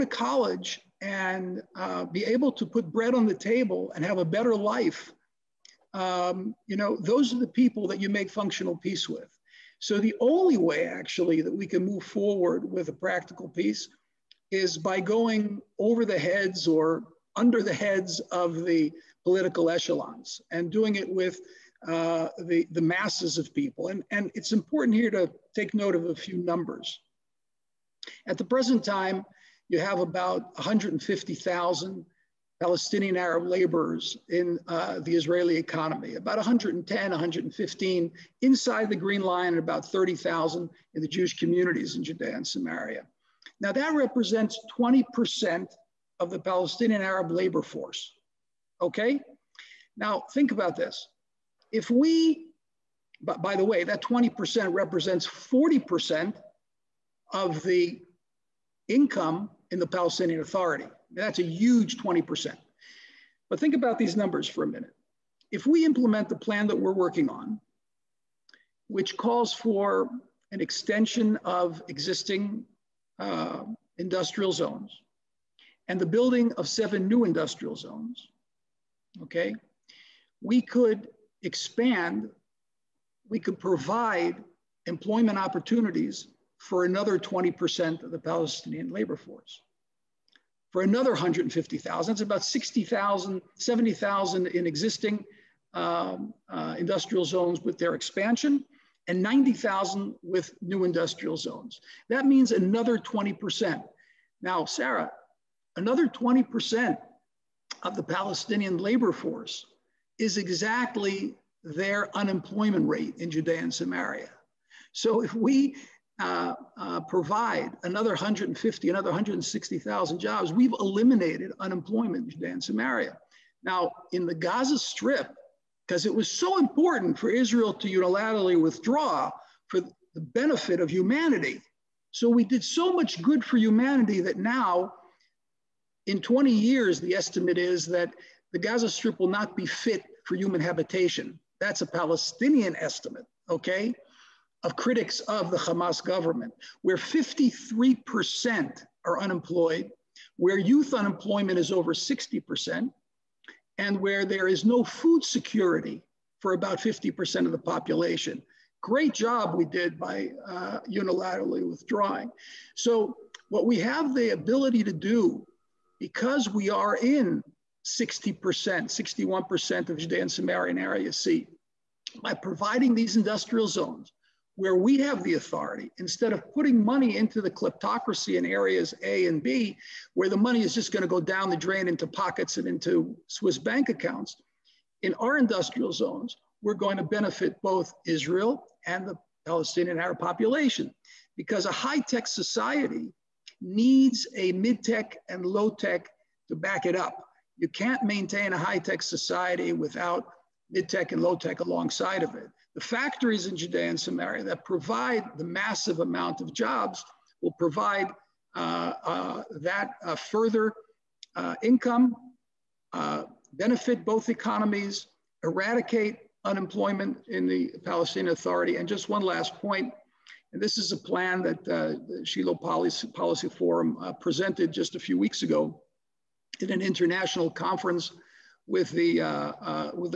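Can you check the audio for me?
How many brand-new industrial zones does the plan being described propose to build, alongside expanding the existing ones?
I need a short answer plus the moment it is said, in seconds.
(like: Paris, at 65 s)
7, at 76 s.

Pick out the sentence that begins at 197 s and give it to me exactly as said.
You can't maintain a high-tech society without mid-tech and low-tech alongside of it.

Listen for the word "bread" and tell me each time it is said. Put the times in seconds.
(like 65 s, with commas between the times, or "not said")
2 s.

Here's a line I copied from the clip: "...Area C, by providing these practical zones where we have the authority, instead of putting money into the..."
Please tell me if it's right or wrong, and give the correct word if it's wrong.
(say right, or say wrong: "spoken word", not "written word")
wrong: "industrial", not "practical".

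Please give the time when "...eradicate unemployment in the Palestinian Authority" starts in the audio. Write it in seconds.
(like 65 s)
215 s.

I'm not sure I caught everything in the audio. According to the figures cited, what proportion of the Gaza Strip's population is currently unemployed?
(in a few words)
53%.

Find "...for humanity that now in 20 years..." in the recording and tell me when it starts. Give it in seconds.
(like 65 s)
133 s.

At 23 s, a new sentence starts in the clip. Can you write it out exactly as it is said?
And, and it's important here to take note of a few numbers.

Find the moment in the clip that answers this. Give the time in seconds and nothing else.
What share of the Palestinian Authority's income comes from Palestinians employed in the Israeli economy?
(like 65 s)
55 s.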